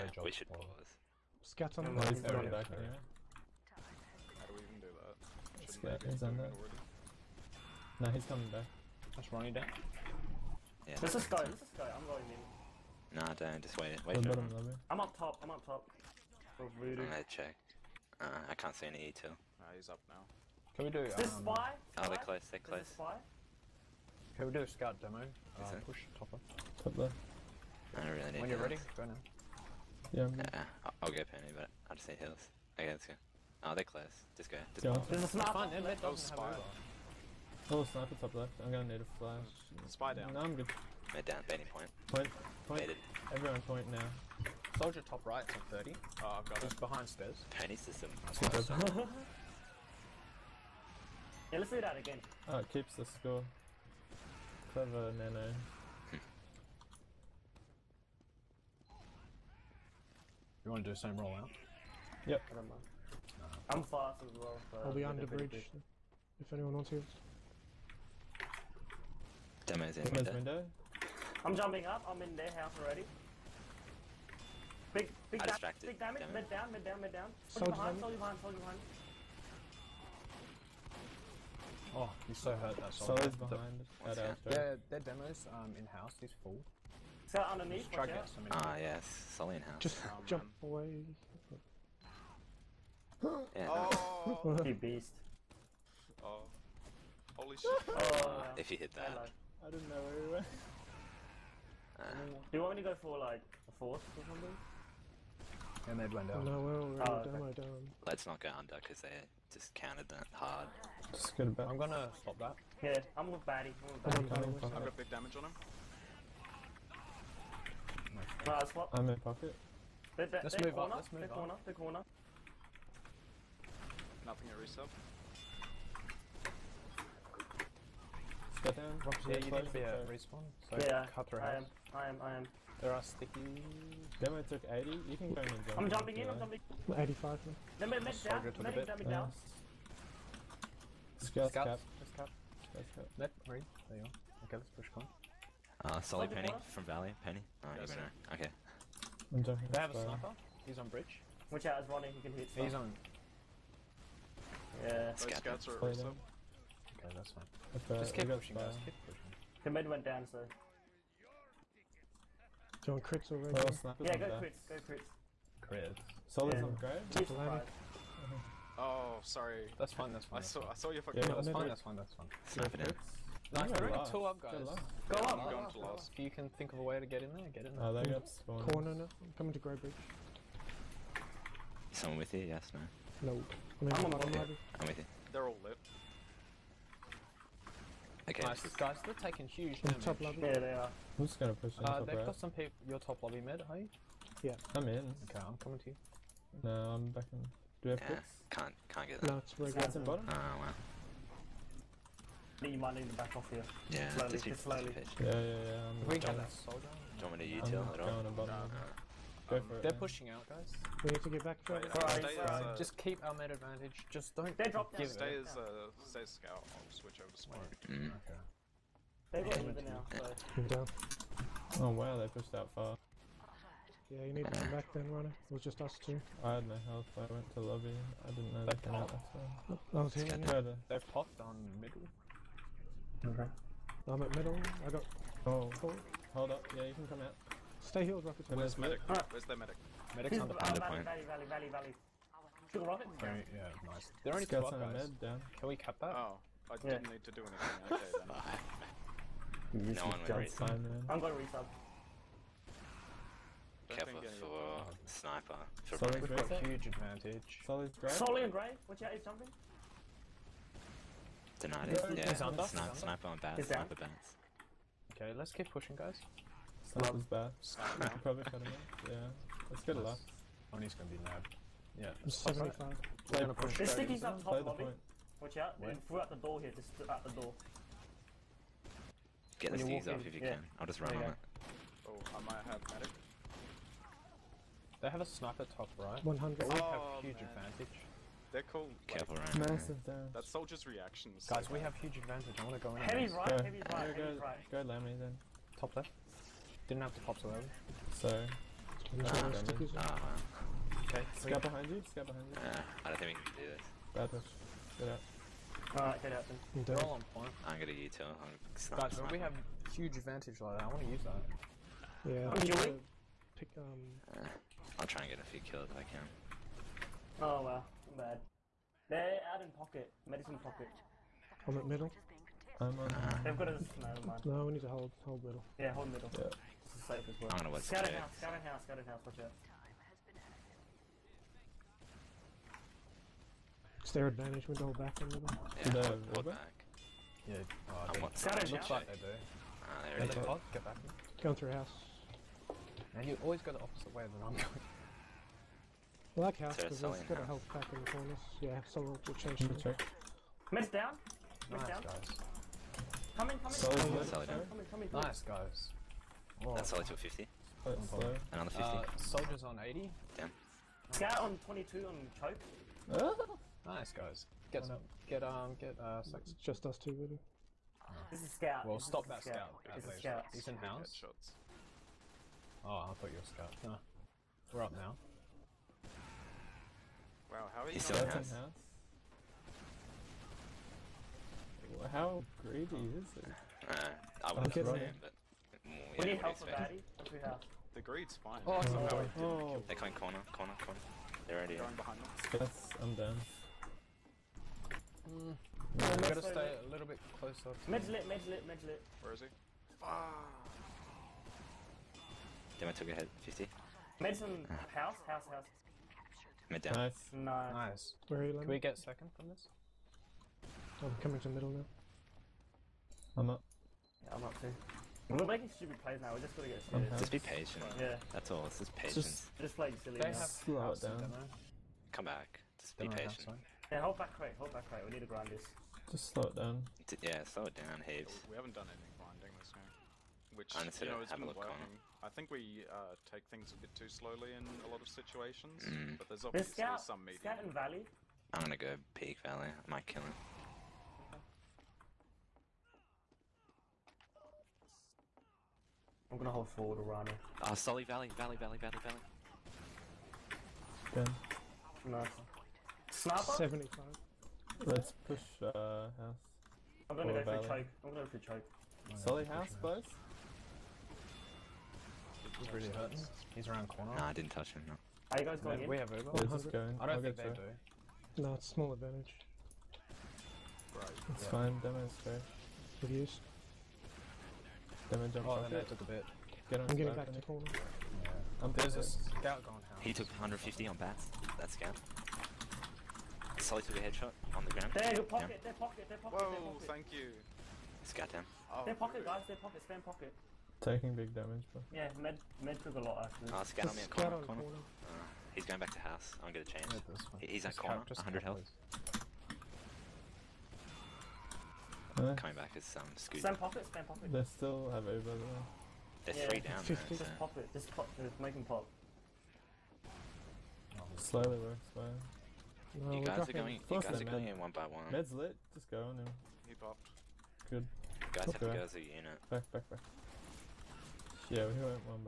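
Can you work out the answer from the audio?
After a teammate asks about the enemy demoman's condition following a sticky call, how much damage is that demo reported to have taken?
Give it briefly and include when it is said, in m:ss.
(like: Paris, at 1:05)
80, at 2:14.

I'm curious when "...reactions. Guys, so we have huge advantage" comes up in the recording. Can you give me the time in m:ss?
4:50.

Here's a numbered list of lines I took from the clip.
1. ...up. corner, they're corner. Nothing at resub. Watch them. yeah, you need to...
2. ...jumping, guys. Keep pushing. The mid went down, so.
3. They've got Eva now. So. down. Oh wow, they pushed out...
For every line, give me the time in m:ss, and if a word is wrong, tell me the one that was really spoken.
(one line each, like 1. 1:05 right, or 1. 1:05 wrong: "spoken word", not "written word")
1. 2:01 right
2. 2:38 wrong: "pushing", not "jumping"
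3. 3:39 right.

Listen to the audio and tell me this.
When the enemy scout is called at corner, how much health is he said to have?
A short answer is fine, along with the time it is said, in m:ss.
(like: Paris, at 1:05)
100, at 8:18.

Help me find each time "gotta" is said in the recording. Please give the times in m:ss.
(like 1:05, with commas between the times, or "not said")
6:36.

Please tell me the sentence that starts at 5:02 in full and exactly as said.
Uh, I don't think we can do this.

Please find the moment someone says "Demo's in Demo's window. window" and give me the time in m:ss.
1:09.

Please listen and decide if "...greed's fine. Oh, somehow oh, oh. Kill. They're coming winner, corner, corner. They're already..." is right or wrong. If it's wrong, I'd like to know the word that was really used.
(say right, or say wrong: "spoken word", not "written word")
wrong: "corner", not "winner".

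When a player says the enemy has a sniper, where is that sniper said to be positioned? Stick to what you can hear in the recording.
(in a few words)
On bridge.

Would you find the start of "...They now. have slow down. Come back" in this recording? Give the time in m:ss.
7:00.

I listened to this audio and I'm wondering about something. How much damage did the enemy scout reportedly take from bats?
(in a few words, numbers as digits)
150.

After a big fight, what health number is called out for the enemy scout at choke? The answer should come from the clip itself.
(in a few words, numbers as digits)
22.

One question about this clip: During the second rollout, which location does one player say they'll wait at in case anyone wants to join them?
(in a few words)
Under bridge.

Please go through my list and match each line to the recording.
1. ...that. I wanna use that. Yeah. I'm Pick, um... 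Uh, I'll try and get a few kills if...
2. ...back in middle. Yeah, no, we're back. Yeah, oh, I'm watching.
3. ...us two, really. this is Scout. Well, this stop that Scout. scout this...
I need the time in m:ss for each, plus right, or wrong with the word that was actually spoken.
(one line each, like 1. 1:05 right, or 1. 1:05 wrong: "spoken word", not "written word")
1. 5:10 right
2. 5:34 right
3. 6:06 right.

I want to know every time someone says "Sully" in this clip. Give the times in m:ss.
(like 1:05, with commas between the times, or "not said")
1:29, 8:03.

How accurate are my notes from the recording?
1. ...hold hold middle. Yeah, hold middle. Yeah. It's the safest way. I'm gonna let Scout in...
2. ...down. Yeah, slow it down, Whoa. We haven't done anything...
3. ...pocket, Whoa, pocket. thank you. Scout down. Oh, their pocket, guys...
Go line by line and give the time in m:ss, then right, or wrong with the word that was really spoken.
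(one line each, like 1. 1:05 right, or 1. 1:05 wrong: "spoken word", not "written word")
1. 5:24 right
2. 7:06 wrong: "Heaves", not "Whoa"
3. 8:06 right.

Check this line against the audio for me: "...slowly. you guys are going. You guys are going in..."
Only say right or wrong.
right.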